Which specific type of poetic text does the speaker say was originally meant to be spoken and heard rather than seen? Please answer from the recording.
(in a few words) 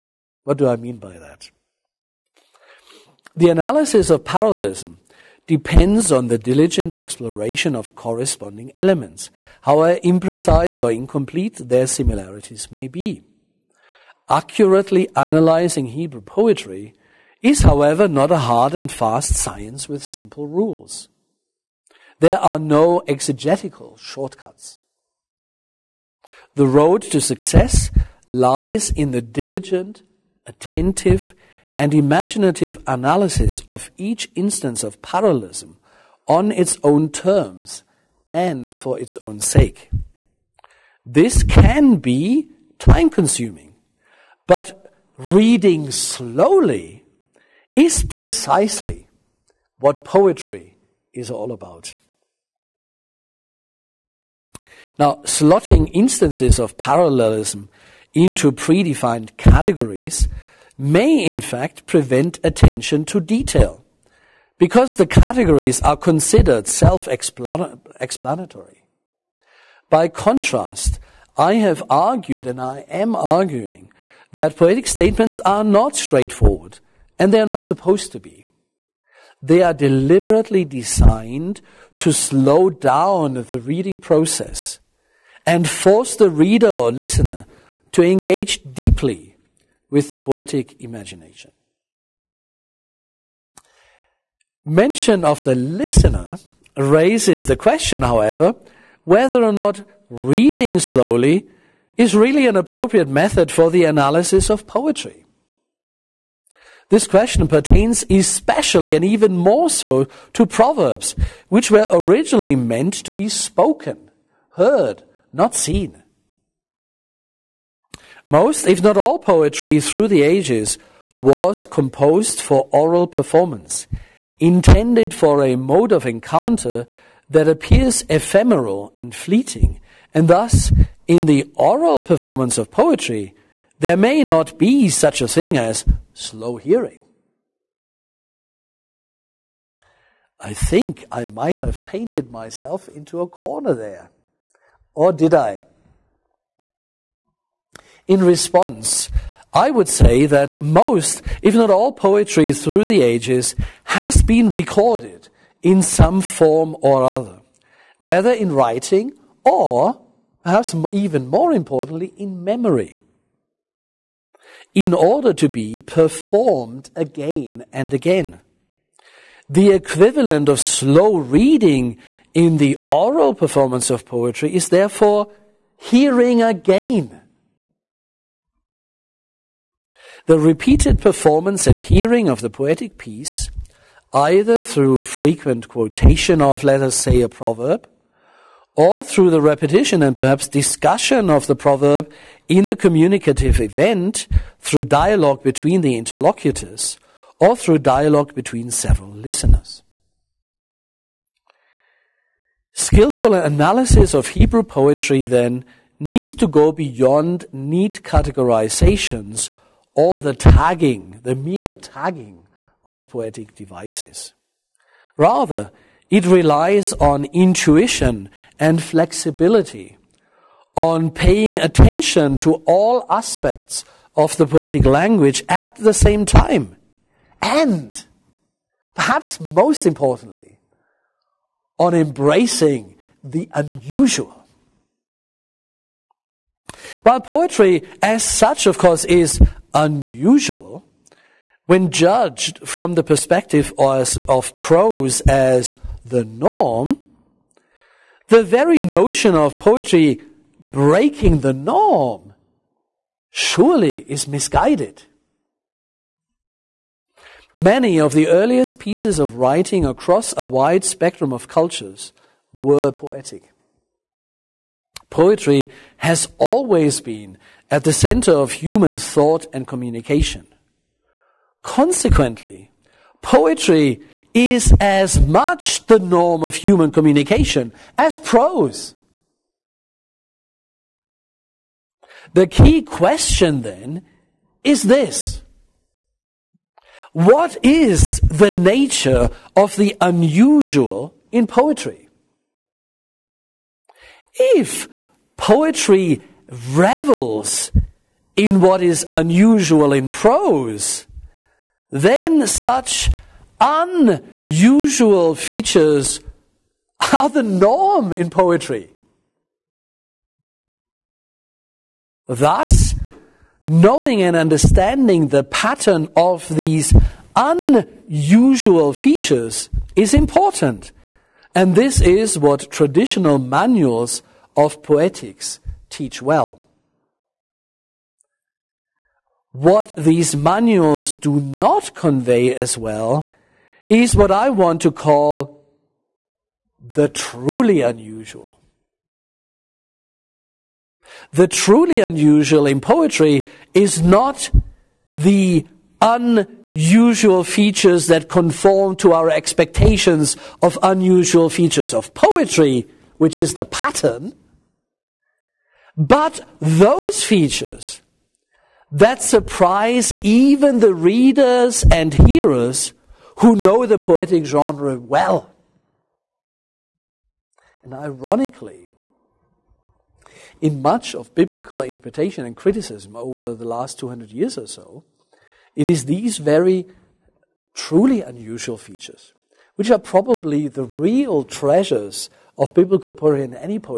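Proverbs.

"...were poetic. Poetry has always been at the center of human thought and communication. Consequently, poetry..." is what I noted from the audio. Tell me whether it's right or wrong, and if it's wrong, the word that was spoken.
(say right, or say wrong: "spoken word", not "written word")
right.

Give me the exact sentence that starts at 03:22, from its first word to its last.
Skillful analysis of Hebrew poetry, then, needs to go beyond neat categorizations all the tagging, the mere tagging of poetic devices.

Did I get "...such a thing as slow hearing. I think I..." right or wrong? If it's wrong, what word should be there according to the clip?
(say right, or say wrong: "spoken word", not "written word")
right.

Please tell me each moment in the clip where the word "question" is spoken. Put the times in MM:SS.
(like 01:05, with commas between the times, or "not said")
01:37, 01:47, 04:42.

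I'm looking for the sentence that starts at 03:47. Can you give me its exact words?
And, perhaps most importantly, on embracing the unusual.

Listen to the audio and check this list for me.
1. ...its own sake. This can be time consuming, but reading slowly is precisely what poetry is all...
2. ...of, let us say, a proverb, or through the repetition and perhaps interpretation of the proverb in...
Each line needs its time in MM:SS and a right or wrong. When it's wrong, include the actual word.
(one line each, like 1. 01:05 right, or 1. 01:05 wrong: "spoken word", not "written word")
1. 00:38 right
2. 03:06 wrong: "discussion", not "interpretation".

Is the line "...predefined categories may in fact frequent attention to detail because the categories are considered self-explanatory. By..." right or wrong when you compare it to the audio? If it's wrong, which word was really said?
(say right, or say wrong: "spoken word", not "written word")
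wrong: "prevent", not "frequent".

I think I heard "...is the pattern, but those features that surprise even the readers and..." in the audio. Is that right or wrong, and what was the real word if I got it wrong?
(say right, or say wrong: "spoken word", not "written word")
right.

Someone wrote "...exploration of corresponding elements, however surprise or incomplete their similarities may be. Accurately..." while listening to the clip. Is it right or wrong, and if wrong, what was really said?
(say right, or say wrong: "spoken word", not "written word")
wrong: "imprecise", not "surprise".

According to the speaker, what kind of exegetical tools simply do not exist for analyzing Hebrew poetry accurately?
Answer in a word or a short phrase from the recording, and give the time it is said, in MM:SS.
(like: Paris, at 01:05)
Shortcuts, at 00:23.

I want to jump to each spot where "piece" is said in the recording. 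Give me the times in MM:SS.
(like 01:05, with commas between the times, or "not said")
03:02, 04:18.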